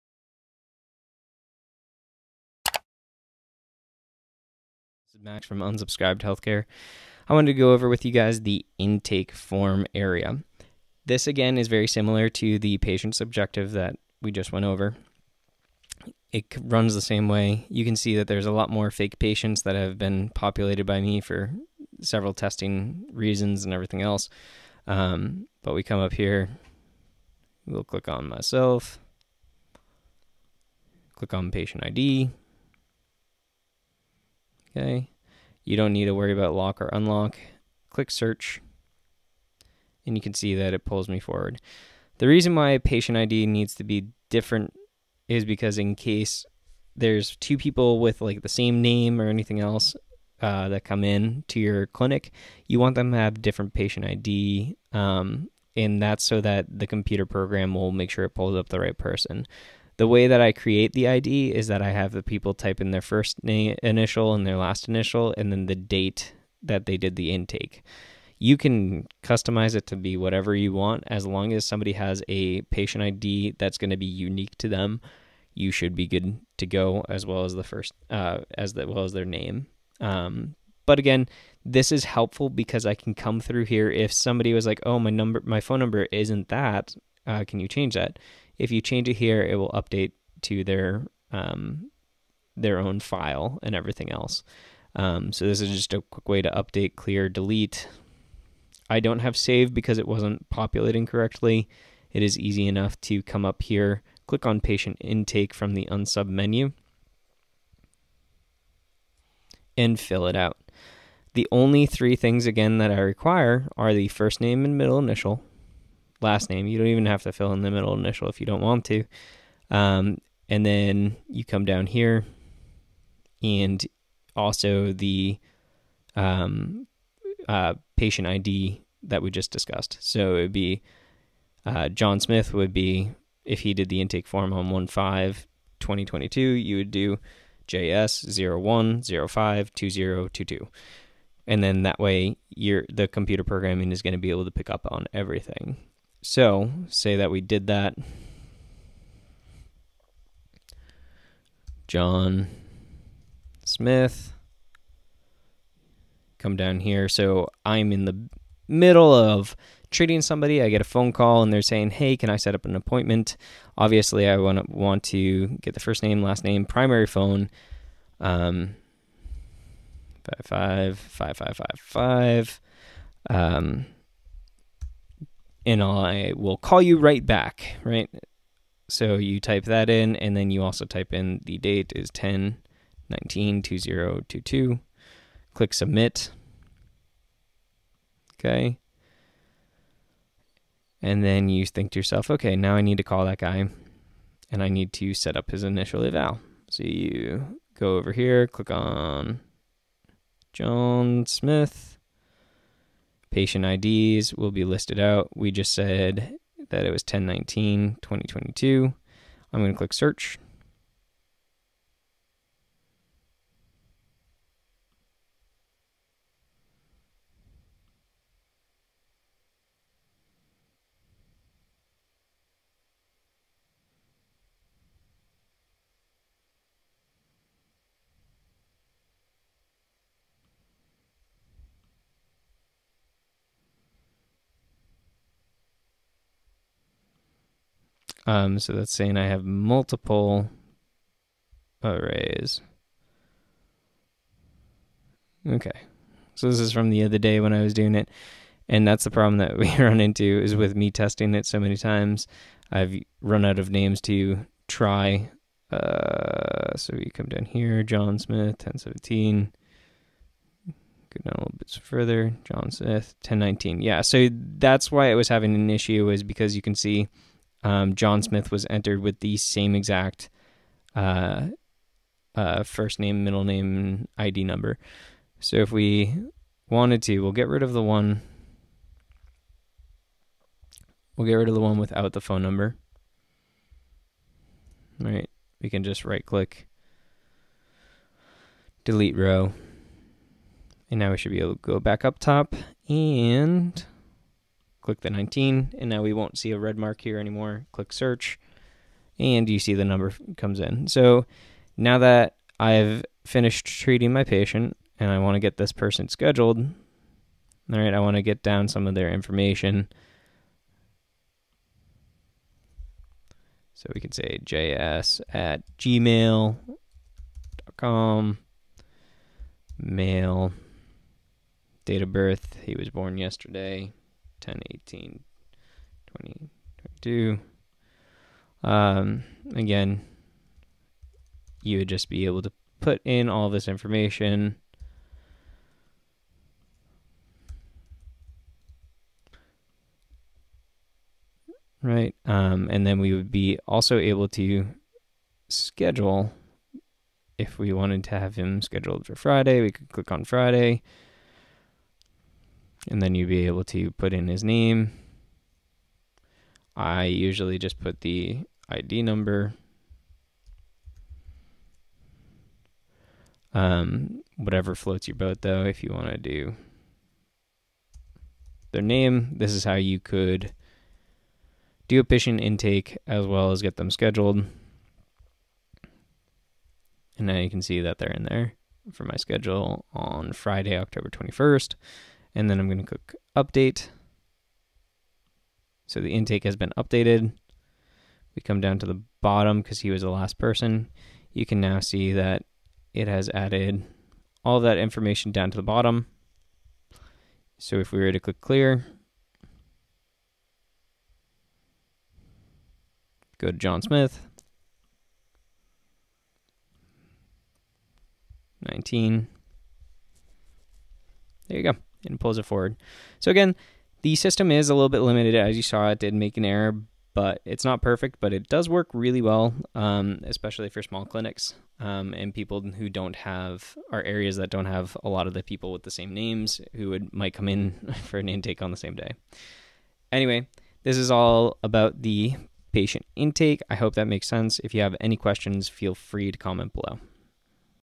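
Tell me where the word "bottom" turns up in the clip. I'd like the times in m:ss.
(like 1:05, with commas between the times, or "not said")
6:29, 6:35.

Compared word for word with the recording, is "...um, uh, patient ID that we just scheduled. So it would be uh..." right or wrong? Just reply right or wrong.
wrong.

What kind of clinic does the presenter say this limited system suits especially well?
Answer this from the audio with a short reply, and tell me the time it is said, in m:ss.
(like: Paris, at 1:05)
Small clinics, at 7:00.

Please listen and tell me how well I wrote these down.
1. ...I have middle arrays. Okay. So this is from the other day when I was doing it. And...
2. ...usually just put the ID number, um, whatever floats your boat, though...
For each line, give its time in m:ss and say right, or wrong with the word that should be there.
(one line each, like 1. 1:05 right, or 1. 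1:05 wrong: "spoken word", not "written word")
1. 3:59 wrong: "multiple", not "middle"
2. 5:57 right.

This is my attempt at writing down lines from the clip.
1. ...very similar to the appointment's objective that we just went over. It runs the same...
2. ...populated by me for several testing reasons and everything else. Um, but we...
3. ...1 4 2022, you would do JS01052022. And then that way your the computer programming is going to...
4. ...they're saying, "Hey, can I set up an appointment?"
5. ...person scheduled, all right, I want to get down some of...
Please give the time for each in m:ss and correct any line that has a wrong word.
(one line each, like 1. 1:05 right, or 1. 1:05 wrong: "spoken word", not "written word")
1. 0:11 wrong: "patient", not "appointment"
2. 0:20 right
3. 2:14 wrong: "5", not "4"
4. 2:41 right
5. 5:05 right.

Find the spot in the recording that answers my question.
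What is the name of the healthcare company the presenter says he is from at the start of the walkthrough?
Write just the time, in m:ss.
0:05.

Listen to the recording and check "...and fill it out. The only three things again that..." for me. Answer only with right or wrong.
right.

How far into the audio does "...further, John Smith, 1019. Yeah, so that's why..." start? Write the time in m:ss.
4:21.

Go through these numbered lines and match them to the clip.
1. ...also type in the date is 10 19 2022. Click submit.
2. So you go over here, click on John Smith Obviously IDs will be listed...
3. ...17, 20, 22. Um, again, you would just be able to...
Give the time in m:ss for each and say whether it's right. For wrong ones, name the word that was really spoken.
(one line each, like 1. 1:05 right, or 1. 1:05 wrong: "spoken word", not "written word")
1. 3:00 right
2. 3:16 wrong: "Patient", not "Obviously"
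3. 5:24 wrong: "18", not "17".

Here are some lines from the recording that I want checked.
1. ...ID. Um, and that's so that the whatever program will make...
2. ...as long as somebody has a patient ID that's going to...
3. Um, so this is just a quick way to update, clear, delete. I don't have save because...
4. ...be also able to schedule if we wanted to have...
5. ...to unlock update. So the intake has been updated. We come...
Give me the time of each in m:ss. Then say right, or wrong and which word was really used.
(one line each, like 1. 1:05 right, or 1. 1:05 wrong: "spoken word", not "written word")
1. 0:54 wrong: "computer", not "whatever"
2. 1:11 right
3. 1:34 right
4. 5:43 right
5. 6:22 wrong: "click", not "unlock".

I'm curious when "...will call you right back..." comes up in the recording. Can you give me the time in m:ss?
2:56.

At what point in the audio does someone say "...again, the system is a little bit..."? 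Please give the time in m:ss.
6:53.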